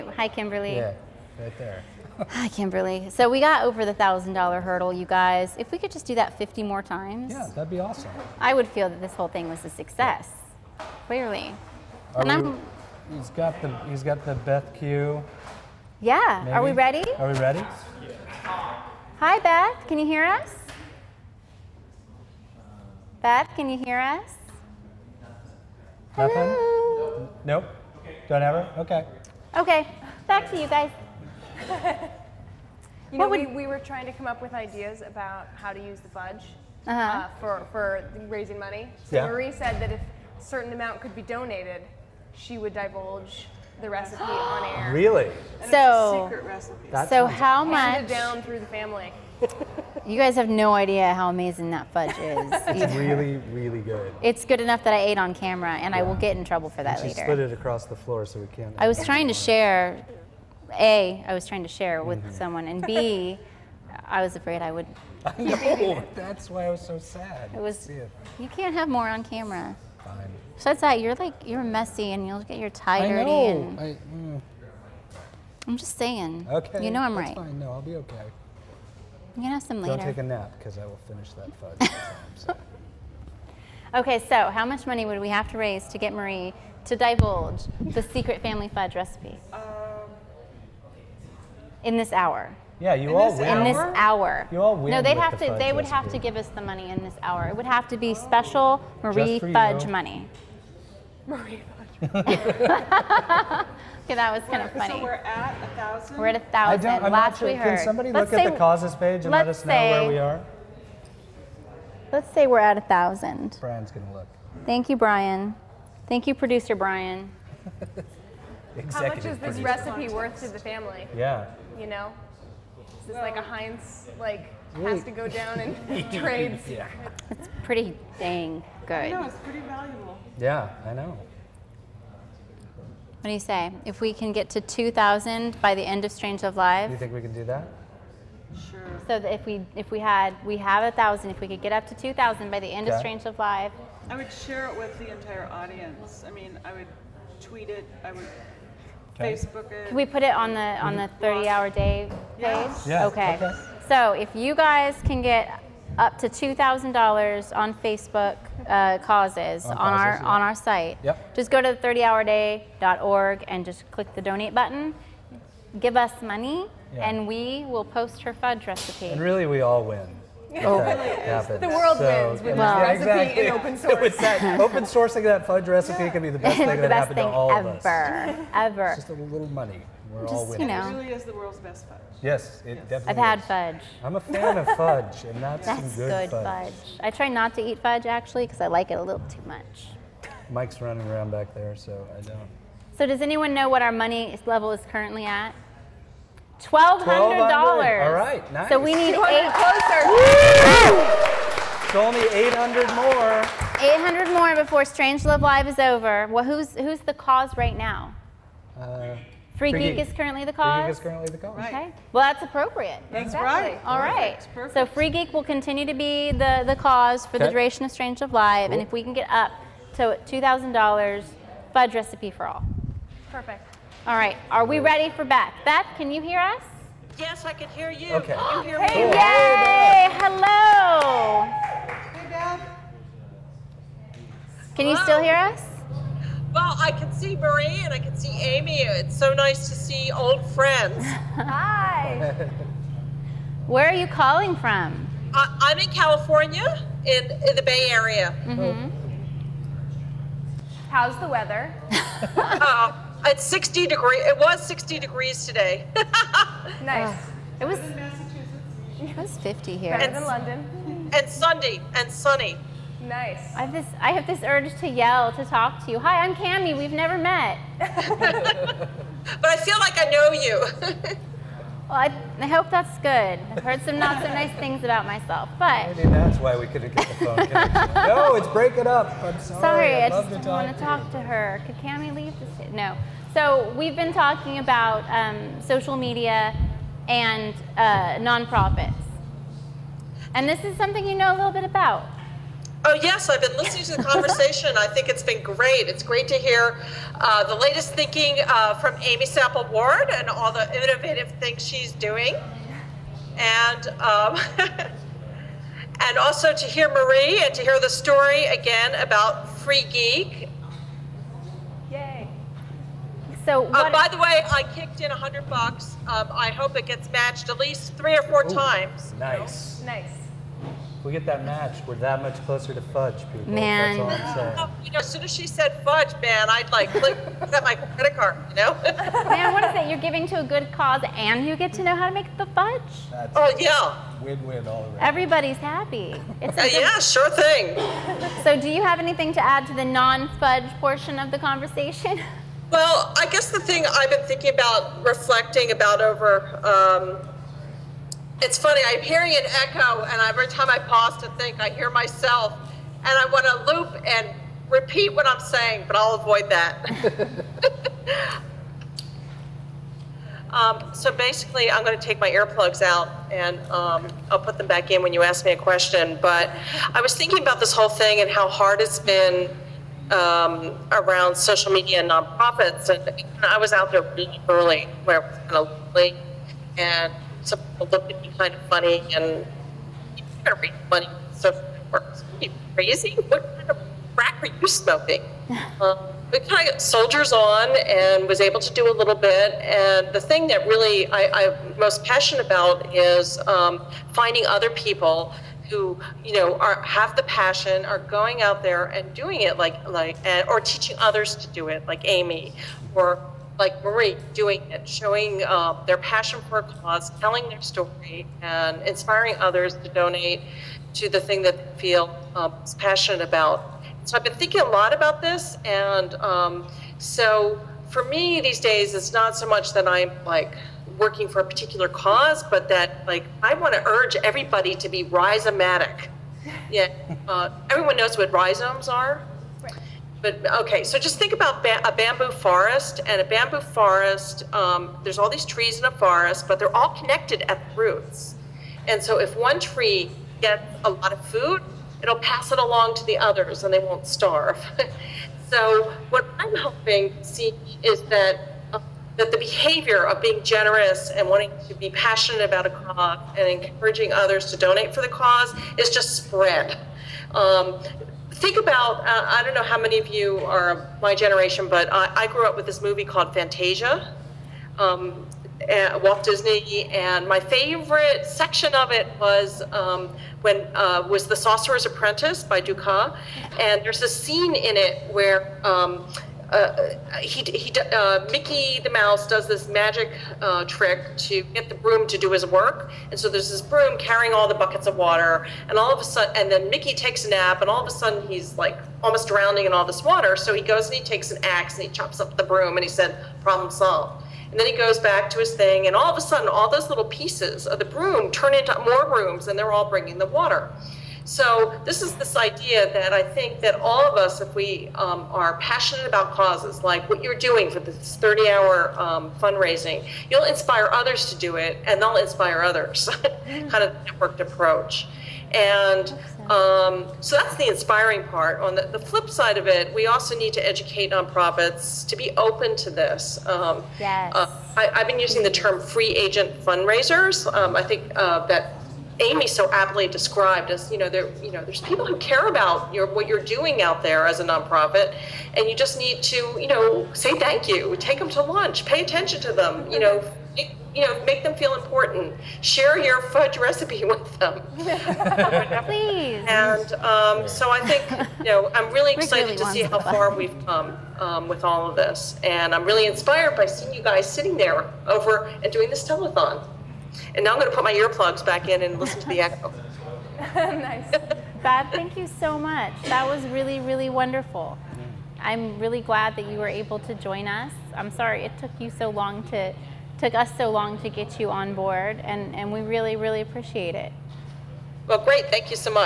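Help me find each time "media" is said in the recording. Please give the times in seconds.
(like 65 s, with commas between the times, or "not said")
285 s, 371 s.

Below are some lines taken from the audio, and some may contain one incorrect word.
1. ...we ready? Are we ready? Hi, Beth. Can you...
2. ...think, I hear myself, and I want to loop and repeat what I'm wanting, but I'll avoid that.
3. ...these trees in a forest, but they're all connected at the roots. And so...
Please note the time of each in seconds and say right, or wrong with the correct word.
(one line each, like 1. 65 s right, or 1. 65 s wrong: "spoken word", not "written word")
1. 16 s right
2. 351 s wrong: "saying", not "wanting"
3. 435 s right.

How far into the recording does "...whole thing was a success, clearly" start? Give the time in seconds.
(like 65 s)
9 s.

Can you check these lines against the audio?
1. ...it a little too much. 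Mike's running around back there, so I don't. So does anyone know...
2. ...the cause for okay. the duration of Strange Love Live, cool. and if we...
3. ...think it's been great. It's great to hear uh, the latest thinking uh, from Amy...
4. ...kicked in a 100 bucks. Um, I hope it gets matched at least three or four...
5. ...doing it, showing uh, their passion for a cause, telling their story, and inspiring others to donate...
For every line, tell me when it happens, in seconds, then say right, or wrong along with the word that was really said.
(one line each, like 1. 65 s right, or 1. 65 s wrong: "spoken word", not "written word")
1. 188 s right
2. 216 s right
3. 294 s right
4. 314 s right
5. 404 s right.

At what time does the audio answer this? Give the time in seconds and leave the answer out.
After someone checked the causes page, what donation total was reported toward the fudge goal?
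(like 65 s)
196 s.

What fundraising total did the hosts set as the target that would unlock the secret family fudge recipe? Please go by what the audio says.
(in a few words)
$2,000.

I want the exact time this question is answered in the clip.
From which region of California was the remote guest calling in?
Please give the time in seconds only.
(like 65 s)
247 s.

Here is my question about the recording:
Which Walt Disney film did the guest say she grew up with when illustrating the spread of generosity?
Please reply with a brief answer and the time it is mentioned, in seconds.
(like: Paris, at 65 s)
Fantasia, at 463 s.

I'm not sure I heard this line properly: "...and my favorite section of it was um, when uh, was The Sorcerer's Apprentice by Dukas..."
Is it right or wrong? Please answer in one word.
right.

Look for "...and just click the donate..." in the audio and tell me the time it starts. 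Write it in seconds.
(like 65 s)
163 s.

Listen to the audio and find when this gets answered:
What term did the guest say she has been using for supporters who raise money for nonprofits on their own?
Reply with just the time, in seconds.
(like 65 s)
525 s.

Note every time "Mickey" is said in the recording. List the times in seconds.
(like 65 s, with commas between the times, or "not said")
478 s, 486 s.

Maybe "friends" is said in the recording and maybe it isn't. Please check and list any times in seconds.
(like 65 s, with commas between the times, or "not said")
240 s.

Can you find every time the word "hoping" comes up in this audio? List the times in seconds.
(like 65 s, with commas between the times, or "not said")
446 s.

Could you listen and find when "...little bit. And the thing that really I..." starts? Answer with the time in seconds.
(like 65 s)
388 s.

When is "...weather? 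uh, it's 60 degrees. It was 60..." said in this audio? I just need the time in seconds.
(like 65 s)
251 s.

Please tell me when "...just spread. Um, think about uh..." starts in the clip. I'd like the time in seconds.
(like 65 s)
455 s.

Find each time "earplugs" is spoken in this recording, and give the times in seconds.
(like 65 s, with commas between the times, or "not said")
362 s, 557 s.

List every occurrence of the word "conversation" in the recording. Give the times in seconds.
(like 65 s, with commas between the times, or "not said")
294 s, 341 s.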